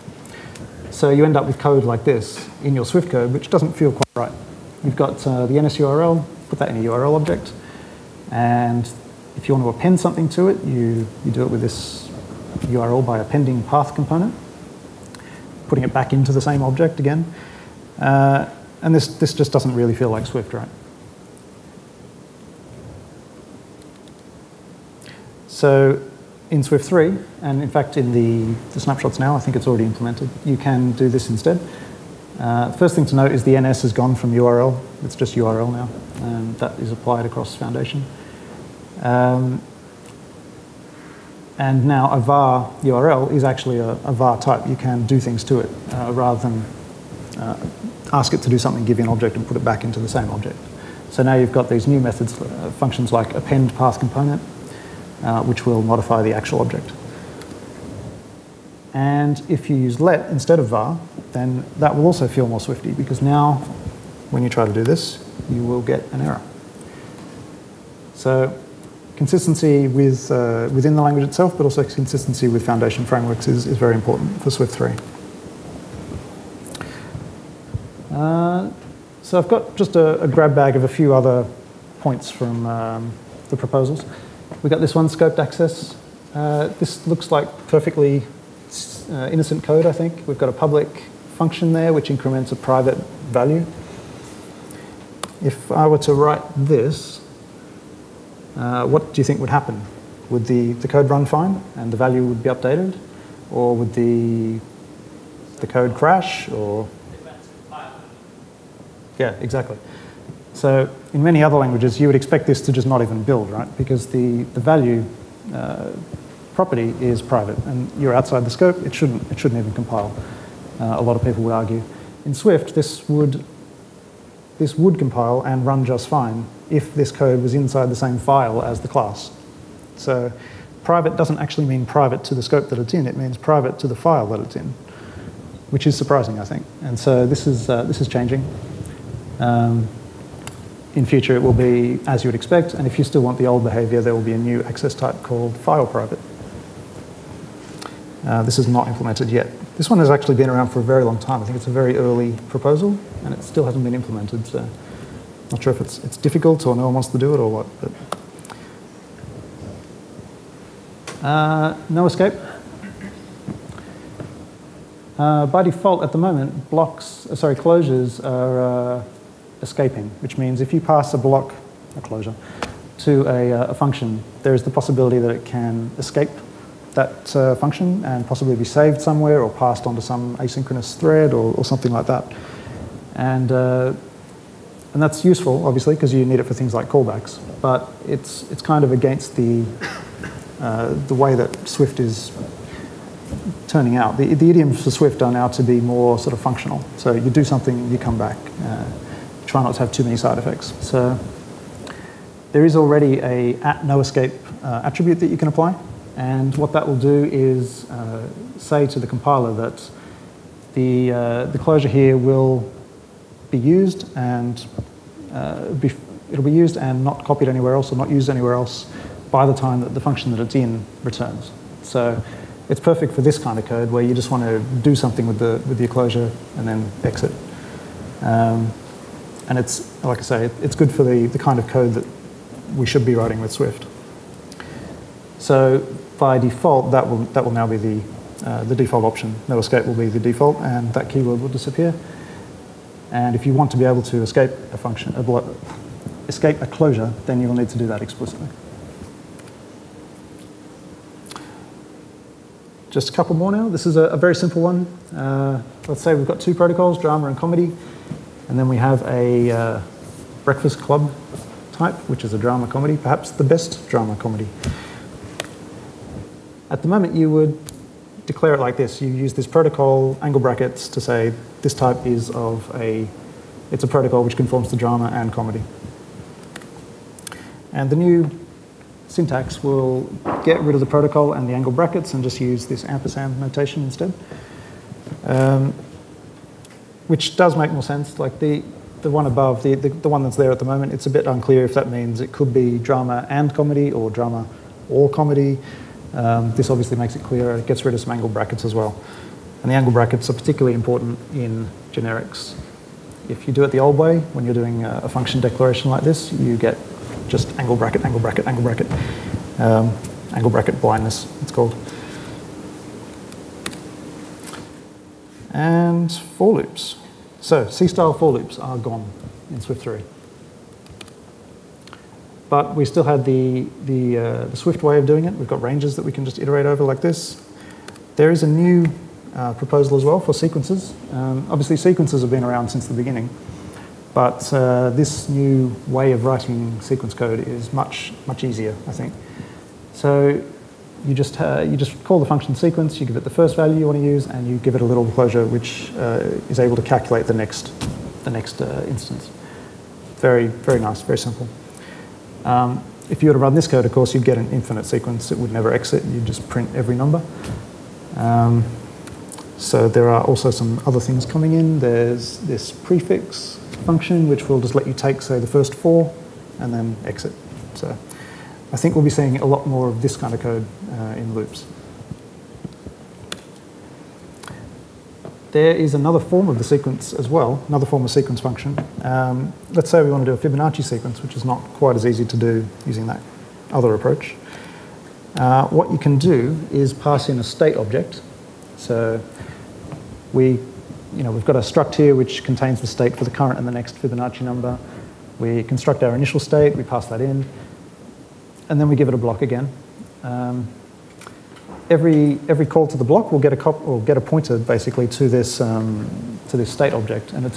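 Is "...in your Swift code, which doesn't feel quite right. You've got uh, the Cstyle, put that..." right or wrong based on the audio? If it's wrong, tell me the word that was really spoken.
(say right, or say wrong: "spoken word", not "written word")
wrong: "NSURL", not "Cstyle".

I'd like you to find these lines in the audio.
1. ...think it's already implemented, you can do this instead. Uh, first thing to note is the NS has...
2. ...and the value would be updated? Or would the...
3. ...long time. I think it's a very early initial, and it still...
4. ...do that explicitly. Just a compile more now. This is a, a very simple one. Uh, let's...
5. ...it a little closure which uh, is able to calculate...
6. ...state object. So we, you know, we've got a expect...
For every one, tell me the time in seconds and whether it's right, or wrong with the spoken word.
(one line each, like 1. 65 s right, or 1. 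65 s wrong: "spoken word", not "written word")
1. 29 s right
2. 101 s right
3. 151 s wrong: "proposal", not "initial"
4. 247 s wrong: "couple", not "compile"
5. 344 s right
6. 387 s wrong: "struct", not "expect".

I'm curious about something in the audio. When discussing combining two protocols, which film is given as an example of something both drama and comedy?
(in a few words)
Breakfast Club.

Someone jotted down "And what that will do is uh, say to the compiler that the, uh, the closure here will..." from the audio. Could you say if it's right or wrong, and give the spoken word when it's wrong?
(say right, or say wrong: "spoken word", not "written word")
right.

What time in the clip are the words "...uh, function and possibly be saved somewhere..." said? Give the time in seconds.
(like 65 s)
177 s.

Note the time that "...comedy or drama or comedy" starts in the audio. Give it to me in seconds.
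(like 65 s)
293 s.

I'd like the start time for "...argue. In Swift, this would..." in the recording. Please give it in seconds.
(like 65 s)
121 s.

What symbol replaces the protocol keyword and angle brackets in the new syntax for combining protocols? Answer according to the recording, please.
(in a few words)
ampersand.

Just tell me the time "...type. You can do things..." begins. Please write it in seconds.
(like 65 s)
44 s.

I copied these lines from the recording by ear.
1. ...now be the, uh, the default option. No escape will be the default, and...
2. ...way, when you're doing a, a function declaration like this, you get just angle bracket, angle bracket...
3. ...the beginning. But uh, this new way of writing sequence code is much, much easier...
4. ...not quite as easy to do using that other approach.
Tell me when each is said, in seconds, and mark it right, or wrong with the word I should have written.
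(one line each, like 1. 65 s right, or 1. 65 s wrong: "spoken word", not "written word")
1. 237 s right
2. 303 s right
3. 332 s right
4. 381 s right.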